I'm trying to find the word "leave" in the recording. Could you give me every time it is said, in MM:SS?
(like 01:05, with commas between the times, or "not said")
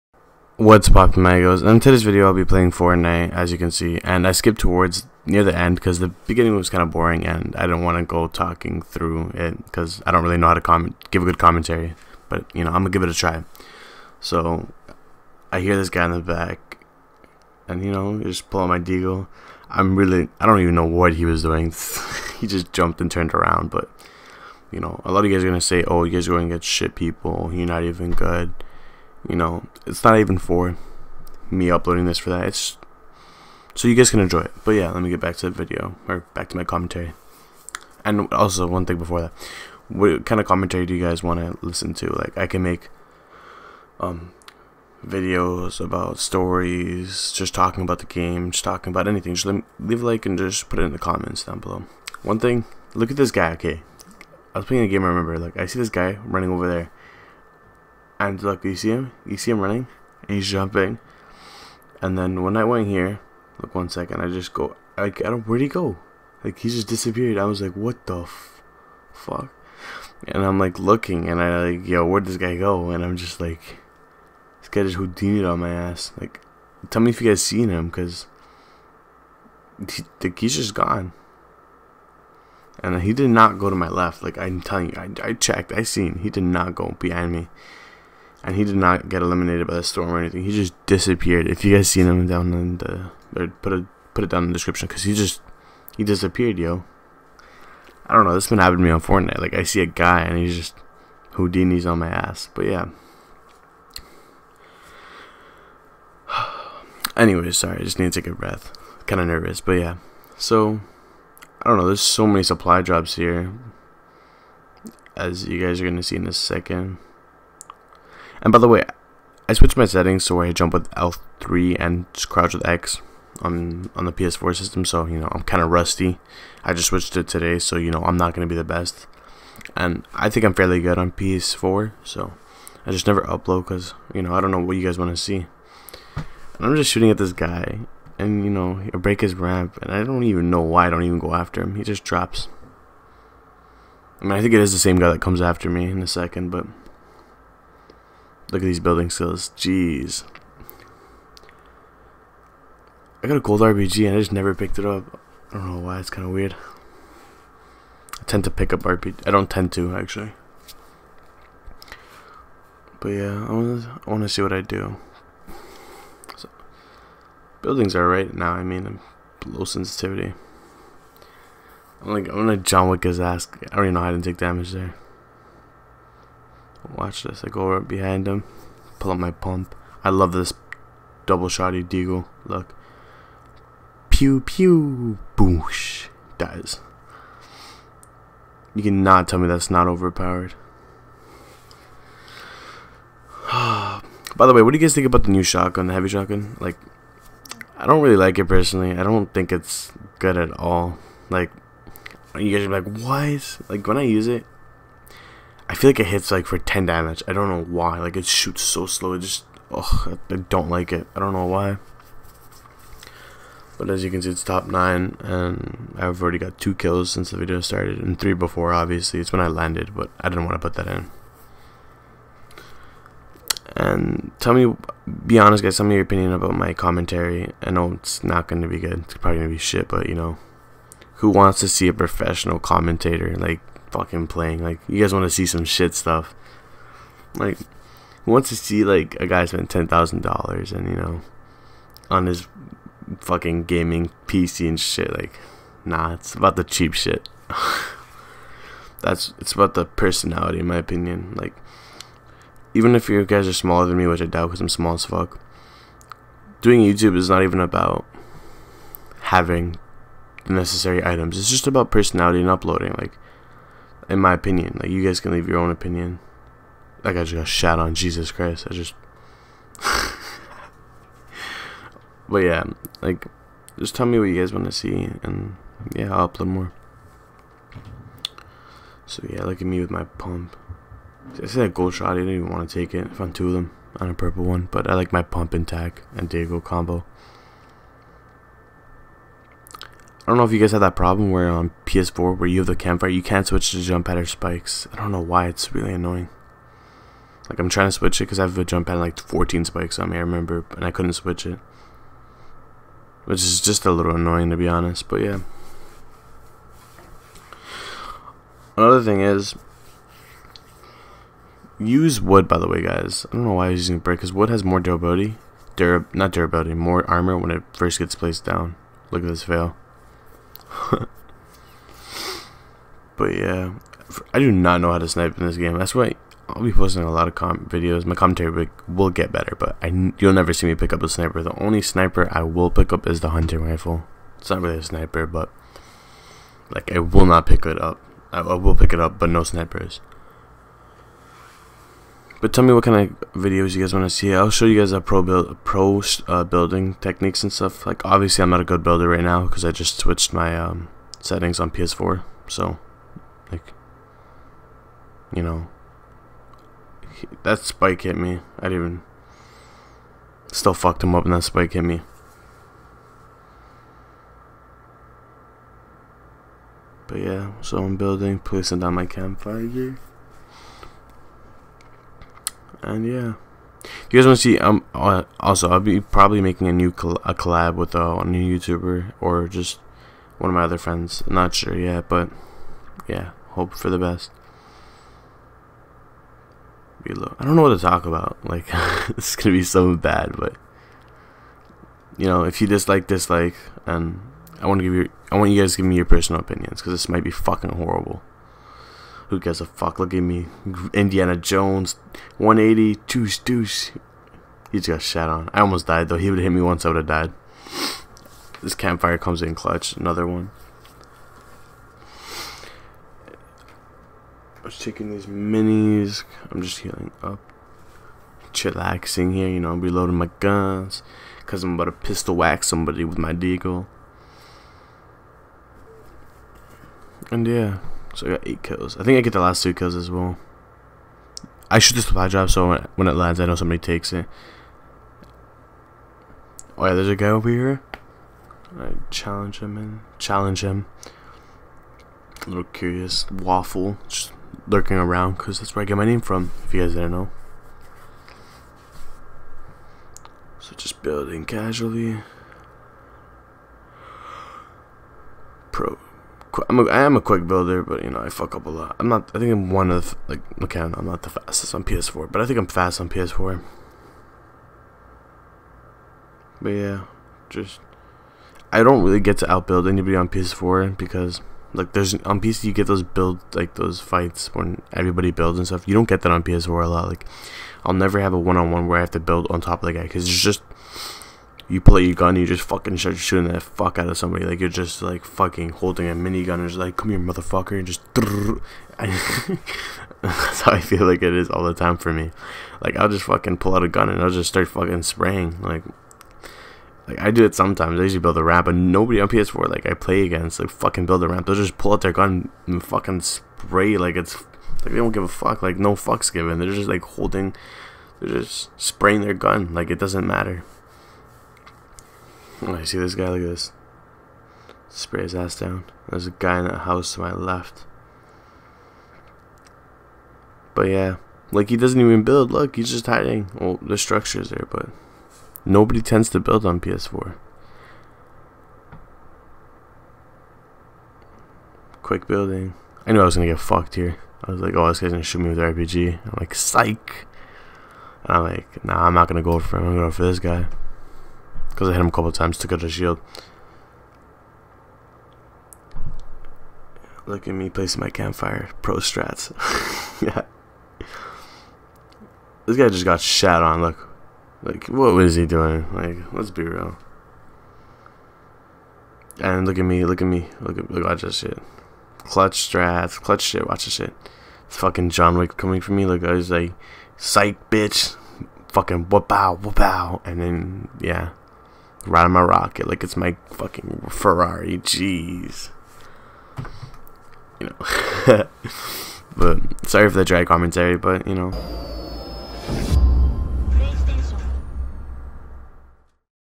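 00:49, 04:25.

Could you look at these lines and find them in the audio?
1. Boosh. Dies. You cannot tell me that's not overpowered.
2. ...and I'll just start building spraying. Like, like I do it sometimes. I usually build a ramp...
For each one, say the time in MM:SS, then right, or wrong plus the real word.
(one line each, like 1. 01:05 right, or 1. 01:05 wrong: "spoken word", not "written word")
1. 03:05 right
2. 08:14 wrong: "fucking", not "building".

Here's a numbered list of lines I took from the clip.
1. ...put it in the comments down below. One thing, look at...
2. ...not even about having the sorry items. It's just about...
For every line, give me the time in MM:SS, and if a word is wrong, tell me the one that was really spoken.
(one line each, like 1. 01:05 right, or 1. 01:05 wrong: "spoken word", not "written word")
1. 00:50 right
2. 04:17 wrong: "necessary", not "sorry".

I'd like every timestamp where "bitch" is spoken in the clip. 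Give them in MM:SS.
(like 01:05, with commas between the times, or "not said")
09:27.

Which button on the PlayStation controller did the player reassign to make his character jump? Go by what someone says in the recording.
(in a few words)
L3.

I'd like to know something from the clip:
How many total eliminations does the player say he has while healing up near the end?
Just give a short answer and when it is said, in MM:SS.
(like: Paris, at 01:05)
8, at 07:08.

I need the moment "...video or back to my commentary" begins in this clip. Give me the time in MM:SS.
00:35.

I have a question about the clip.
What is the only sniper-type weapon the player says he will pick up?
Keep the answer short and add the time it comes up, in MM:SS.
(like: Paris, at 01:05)
Hunting rifle, at 05:33.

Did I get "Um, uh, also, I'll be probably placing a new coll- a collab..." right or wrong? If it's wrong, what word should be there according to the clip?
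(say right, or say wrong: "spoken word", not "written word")
wrong: "making", not "placing".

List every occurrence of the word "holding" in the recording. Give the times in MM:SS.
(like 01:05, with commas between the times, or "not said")
08:05, 08:27.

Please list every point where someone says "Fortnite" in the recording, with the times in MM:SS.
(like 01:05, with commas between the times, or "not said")
00:02, 01:39.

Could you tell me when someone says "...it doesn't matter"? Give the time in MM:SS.
08:29.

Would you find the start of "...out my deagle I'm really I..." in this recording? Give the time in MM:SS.
00:18.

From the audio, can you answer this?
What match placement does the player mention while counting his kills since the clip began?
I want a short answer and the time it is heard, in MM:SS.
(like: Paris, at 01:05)
Top 9, at 03:34.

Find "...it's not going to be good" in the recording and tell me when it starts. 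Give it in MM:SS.
03:47.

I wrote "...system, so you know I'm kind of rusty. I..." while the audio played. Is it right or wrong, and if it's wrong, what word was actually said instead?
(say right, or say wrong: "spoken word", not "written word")
right.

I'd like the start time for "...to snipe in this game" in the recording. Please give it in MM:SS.
05:24.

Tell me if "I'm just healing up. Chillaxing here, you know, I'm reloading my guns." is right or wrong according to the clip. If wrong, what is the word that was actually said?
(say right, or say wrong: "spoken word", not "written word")
right.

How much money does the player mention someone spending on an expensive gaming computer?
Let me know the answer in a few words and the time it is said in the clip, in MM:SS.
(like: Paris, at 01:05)
$10,000, at 03:59.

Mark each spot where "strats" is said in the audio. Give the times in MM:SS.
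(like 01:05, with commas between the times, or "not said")
09:08, 09:22.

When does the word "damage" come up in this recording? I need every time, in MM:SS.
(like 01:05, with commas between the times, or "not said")
02:54, 03:26.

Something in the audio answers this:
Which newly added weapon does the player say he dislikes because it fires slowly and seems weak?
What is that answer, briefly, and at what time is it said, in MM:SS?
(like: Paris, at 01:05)
Heavy shotgun, at 03:15.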